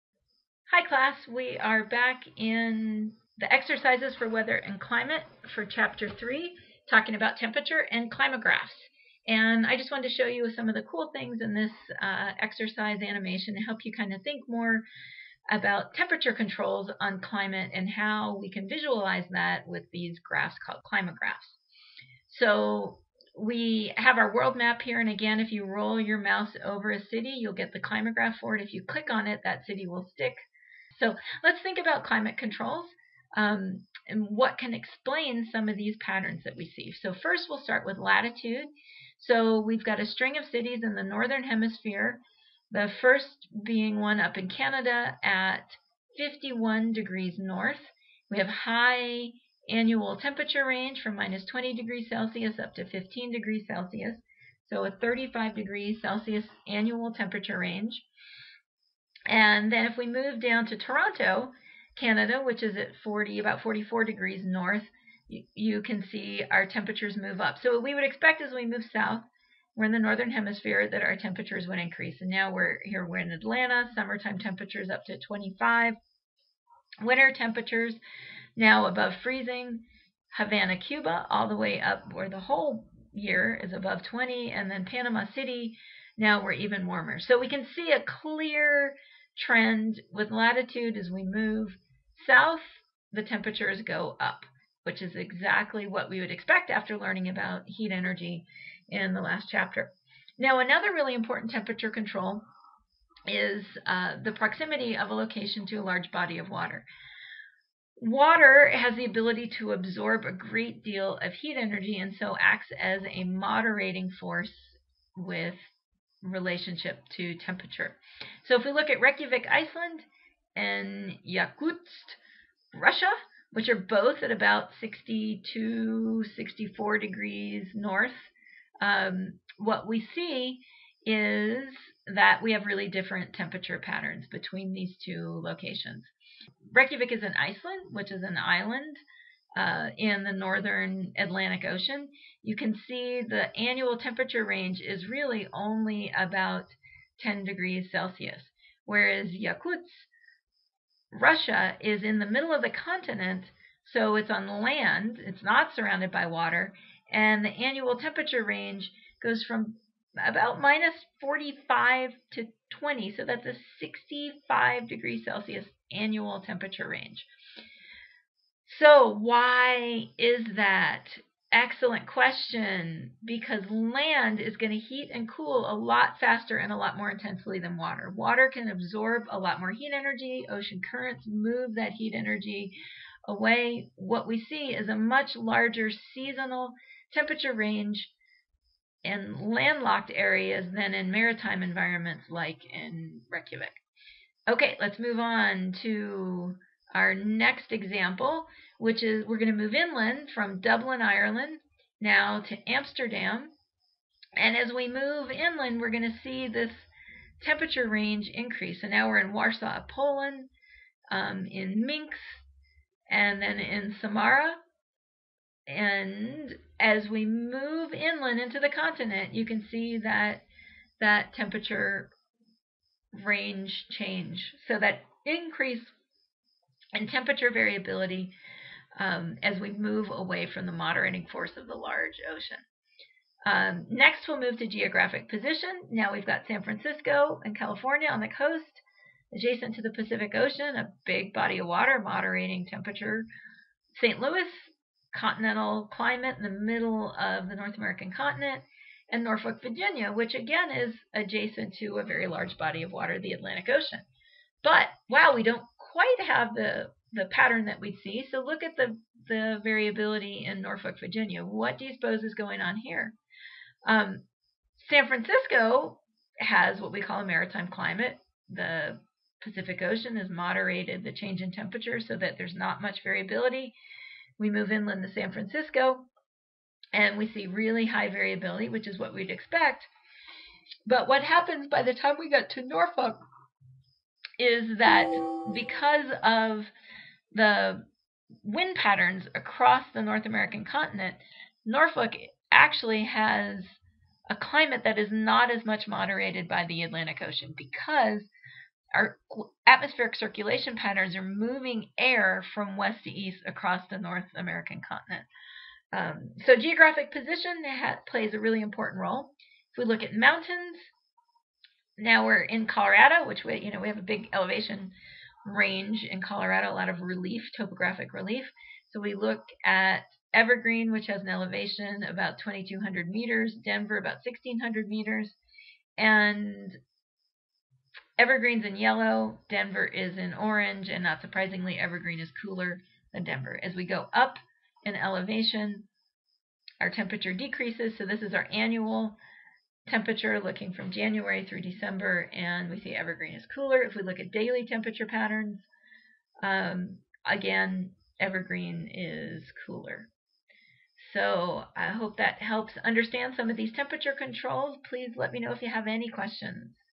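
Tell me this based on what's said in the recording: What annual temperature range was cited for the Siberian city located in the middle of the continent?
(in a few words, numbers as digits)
65 degrees Celsius.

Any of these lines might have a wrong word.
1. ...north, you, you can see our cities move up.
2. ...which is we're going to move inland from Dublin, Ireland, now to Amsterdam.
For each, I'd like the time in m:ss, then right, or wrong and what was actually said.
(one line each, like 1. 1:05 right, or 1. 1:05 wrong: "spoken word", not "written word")
1. 1:04 wrong: "temperatures", not "cities"
2. 3:18 right.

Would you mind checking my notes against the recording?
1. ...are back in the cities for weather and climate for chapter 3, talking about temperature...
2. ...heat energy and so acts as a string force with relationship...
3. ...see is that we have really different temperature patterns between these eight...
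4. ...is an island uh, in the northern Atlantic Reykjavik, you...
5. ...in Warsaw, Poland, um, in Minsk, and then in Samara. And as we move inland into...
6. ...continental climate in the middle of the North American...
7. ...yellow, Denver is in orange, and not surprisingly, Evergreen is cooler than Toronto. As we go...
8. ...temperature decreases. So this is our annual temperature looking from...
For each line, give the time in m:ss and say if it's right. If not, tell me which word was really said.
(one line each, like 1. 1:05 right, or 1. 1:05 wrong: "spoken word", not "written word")
1. 0:01 wrong: "exercises", not "cities"
2. 1:51 wrong: "moderating", not "string"
3. 2:10 wrong: "two", not "eight"
4. 2:18 wrong: "Ocean", not "Reykjavik"
5. 3:29 right
6. 4:05 right
7. 5:28 wrong: "Denver", not "Toronto"
8. 5:36 right.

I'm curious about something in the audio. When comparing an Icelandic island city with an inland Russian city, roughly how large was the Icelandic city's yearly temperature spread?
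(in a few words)
10 degrees Celsius.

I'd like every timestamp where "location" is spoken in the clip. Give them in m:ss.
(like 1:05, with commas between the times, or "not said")
1:45, 2:15.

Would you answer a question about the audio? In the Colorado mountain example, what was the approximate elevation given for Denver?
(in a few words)
1,600 meters.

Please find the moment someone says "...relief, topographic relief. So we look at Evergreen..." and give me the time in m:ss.
5:17.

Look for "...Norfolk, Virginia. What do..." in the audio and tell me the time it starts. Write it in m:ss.
4:20.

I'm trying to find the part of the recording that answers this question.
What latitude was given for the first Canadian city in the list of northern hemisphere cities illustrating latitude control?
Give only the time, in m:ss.
0:46.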